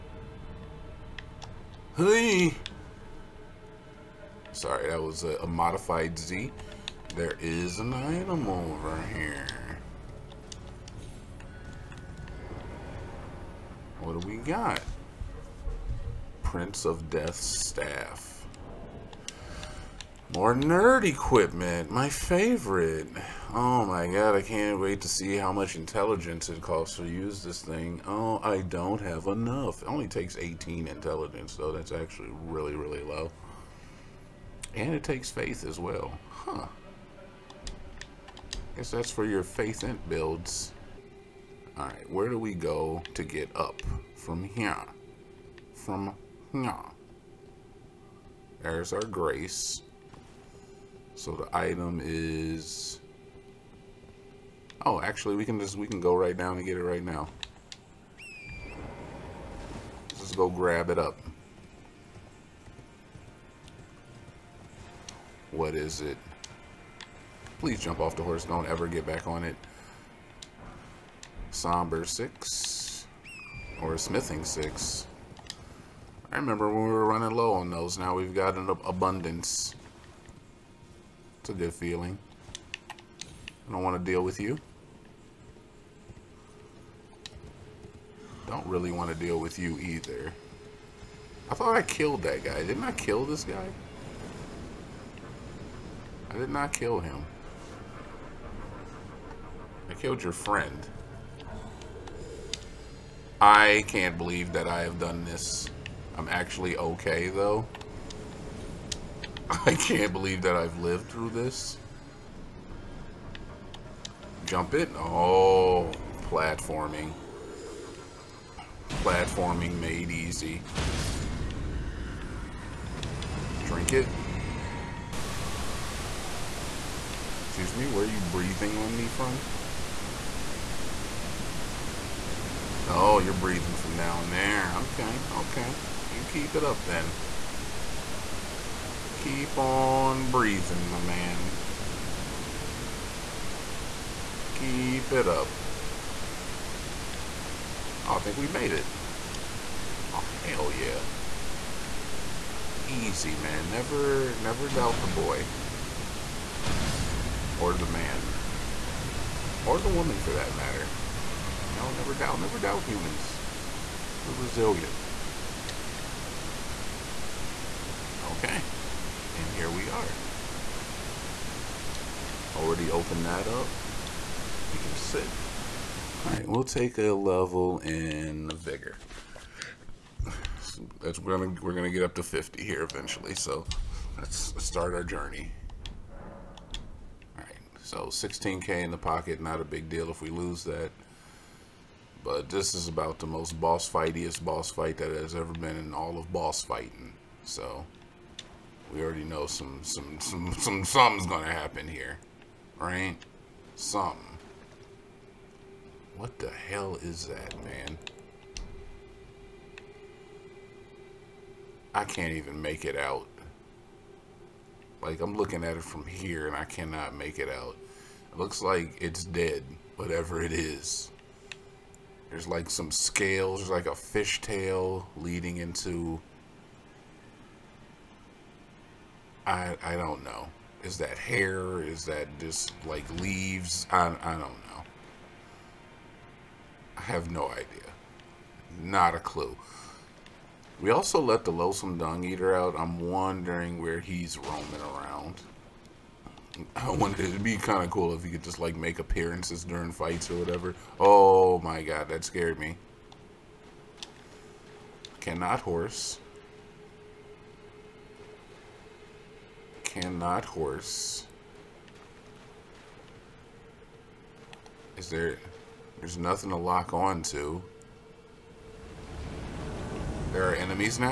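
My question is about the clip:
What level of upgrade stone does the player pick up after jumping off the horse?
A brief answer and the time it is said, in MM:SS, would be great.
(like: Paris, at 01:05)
Smithing 6, at 01:13.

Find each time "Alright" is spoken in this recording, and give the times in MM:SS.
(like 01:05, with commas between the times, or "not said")
02:56, 03:07.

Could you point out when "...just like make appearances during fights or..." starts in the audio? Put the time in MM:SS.
04:08.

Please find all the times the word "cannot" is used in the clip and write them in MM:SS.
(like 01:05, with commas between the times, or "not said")
03:36, 04:15, 04:19.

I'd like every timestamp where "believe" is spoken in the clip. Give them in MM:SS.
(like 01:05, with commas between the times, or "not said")
01:44, 01:50.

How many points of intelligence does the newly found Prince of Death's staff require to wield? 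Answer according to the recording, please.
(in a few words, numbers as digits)
18.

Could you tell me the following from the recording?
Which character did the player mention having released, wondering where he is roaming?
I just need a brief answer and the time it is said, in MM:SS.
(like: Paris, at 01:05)
loathsome dung eater, at 04:01.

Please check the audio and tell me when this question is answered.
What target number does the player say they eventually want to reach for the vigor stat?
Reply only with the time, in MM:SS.
03:02.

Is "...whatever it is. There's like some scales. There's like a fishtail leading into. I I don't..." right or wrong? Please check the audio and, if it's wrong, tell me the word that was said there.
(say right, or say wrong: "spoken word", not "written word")
right.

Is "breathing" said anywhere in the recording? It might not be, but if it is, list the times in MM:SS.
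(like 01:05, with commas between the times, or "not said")
02:08, 02:13, 02:20.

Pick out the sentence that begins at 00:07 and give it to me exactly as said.
There is an item over here.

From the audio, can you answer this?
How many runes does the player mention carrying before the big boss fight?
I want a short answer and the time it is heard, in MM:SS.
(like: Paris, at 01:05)
16k, at 03:08.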